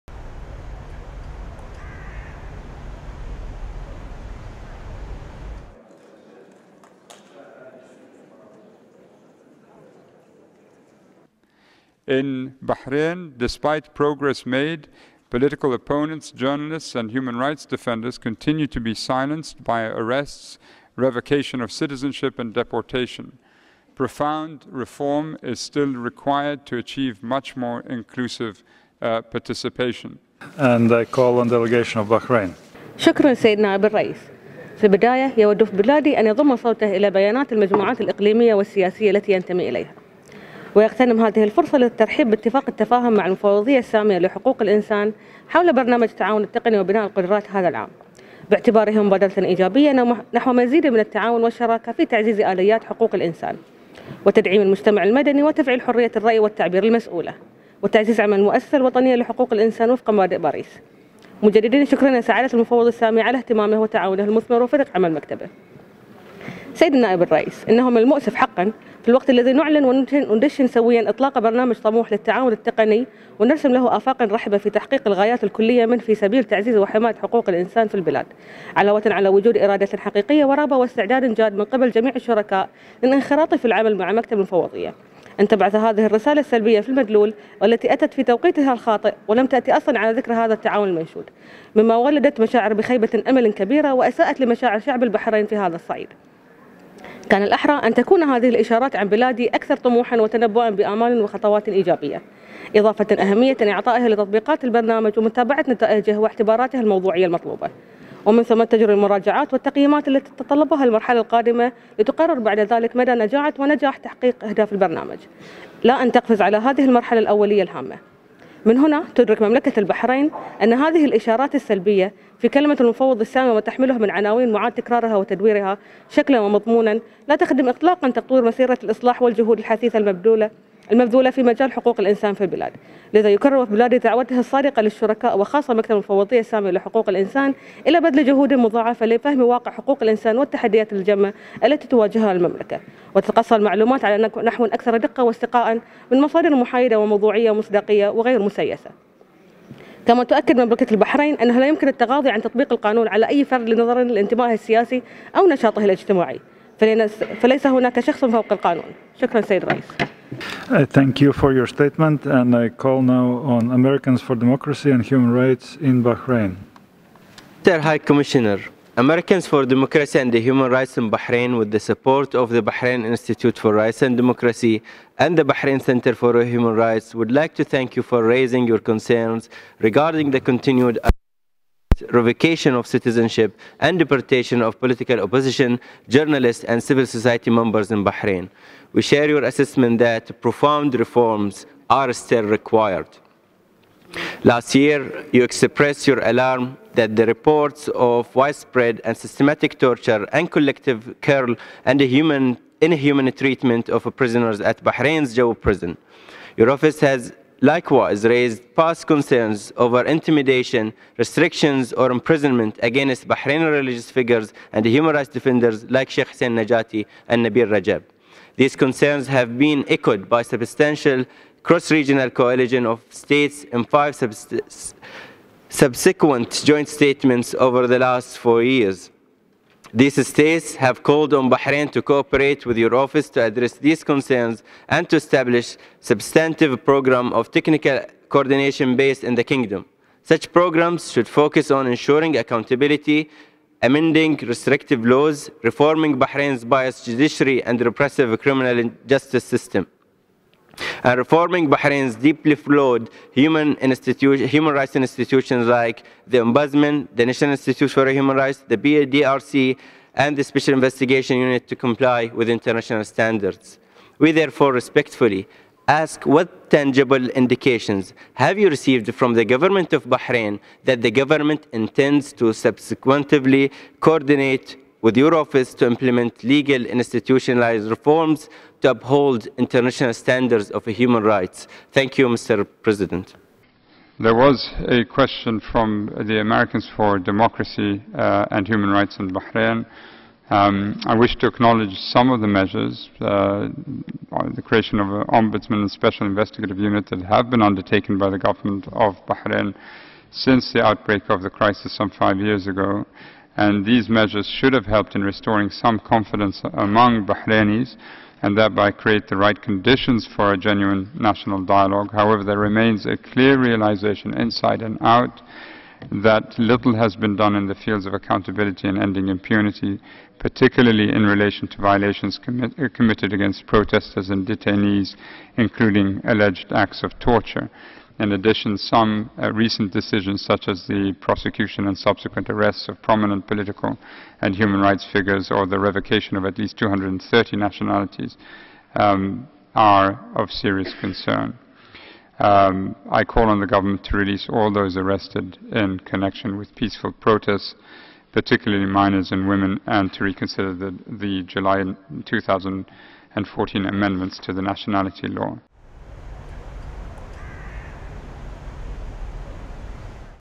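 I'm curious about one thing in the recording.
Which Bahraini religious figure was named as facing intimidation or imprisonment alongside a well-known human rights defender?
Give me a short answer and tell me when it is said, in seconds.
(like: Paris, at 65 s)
Sheikh Hussein Najati, at 216 s.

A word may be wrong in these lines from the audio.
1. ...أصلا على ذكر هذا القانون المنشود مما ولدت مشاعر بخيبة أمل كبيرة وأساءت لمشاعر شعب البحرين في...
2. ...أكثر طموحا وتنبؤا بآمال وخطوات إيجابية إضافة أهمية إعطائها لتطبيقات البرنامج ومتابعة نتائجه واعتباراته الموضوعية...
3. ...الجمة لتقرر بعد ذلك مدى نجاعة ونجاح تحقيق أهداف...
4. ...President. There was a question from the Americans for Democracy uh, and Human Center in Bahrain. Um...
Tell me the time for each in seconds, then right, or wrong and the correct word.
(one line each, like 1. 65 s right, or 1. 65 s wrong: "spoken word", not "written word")
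1. 89 s wrong: "التعاون", not "القانون"
2. 99 s right
3. 111 s wrong: "القادمة", not "الجمة"
4. 282 s wrong: "Rights", not "Center".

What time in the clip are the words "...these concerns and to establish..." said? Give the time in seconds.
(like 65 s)
233 s.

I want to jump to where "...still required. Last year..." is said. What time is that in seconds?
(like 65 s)
192 s.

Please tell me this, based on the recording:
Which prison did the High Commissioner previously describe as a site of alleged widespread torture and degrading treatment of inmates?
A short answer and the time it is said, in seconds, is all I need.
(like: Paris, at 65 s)
Jau prison, at 205 s.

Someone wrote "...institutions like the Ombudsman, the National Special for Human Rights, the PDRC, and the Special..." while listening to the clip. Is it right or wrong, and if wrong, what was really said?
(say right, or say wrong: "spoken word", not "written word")
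wrong: "Institute", not "Special".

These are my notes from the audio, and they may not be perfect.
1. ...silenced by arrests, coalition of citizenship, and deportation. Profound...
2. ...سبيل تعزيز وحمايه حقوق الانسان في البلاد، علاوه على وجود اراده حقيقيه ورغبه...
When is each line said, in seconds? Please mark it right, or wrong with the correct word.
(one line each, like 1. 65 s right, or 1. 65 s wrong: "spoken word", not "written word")
1. 18 s wrong: "revocation", not "coalition"
2. 76 s right.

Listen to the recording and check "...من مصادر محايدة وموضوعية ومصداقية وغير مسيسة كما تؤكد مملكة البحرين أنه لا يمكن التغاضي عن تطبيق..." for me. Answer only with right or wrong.
right.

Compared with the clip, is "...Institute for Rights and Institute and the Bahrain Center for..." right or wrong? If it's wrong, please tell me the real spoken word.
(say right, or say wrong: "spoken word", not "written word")
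wrong: "Democracy", not "Institute".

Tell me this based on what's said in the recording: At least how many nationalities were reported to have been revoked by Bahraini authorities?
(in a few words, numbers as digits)
230.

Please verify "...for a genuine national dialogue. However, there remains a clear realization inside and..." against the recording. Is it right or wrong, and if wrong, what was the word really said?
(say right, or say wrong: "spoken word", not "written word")
right.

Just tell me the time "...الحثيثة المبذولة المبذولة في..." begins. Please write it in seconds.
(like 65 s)
129 s.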